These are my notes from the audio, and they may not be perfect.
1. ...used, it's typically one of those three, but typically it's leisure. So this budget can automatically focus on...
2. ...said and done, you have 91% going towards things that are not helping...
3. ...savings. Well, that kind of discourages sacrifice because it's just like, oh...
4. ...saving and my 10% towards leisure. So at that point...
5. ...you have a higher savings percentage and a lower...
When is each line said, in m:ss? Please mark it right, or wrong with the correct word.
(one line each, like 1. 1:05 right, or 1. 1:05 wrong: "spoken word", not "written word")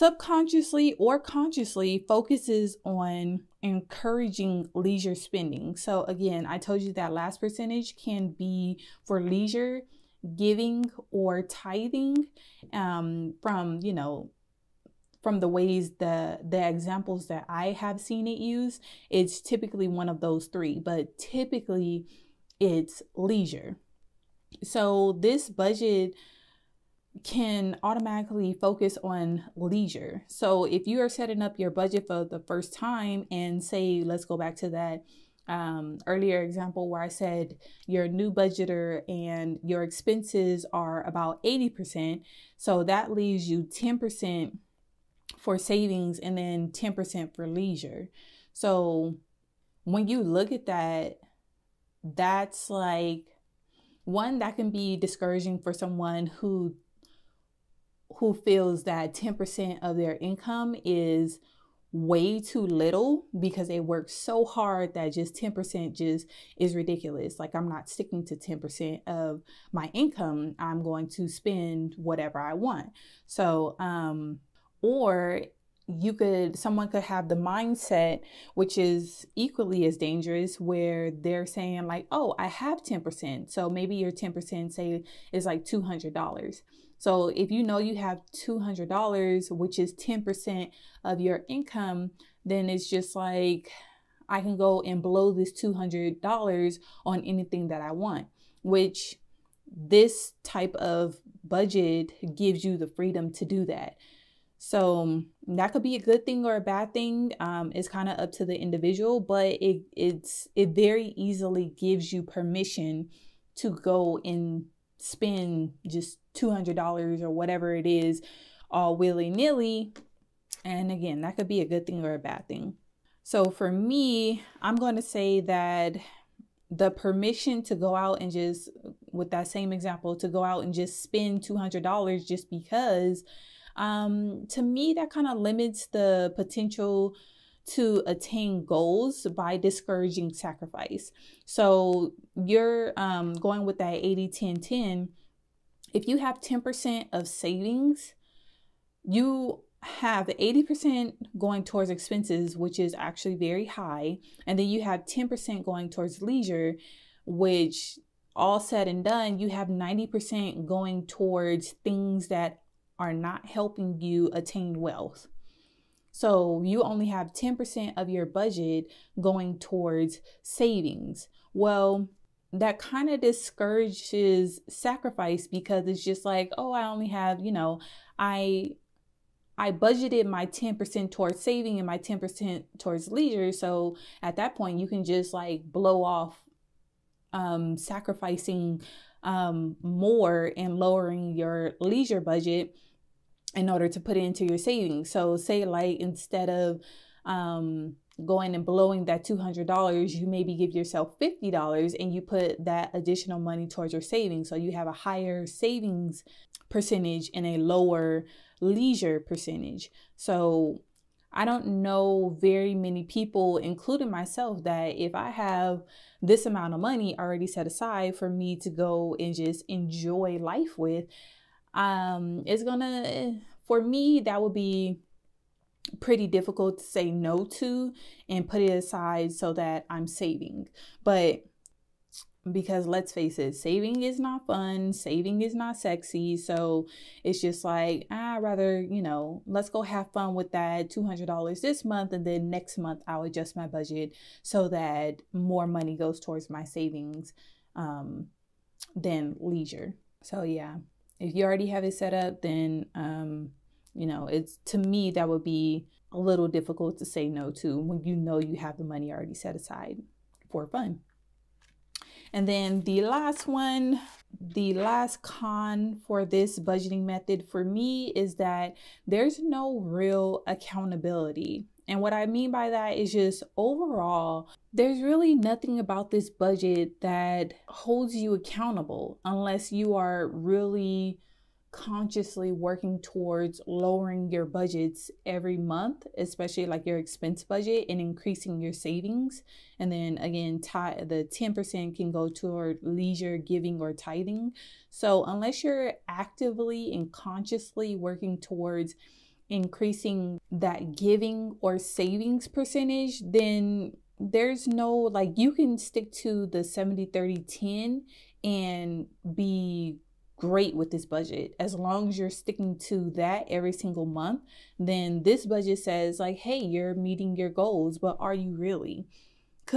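1. 0:18 right
2. 2:38 wrong: "90", not "91"
3. 2:50 right
4. 3:01 right
5. 3:24 right.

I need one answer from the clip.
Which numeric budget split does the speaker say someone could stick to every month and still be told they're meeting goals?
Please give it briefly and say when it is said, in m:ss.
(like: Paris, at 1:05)
70 30 10, at 5:06.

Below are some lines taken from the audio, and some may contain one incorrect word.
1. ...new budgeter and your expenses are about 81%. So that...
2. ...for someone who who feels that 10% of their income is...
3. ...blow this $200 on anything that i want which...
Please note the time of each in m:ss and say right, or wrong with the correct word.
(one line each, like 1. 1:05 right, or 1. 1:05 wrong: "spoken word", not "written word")
1. 0:38 wrong: "80", not "81"
2. 0:55 right
3. 1:35 right.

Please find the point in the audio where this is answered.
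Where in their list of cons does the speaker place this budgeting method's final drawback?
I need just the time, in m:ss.
4:24.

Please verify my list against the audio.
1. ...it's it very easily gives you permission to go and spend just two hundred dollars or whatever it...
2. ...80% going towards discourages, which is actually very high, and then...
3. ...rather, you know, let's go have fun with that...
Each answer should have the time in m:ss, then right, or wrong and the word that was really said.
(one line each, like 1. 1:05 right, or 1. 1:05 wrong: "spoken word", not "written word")
1. 1:49 right
2. 2:30 wrong: "expenses", not "discourages"
3. 3:58 right.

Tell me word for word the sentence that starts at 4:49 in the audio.
And then again, the 10% can go toward leisure, giving, or tithing.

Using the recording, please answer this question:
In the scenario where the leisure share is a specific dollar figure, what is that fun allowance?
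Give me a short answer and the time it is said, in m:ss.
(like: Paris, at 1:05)
$200, at 1:28.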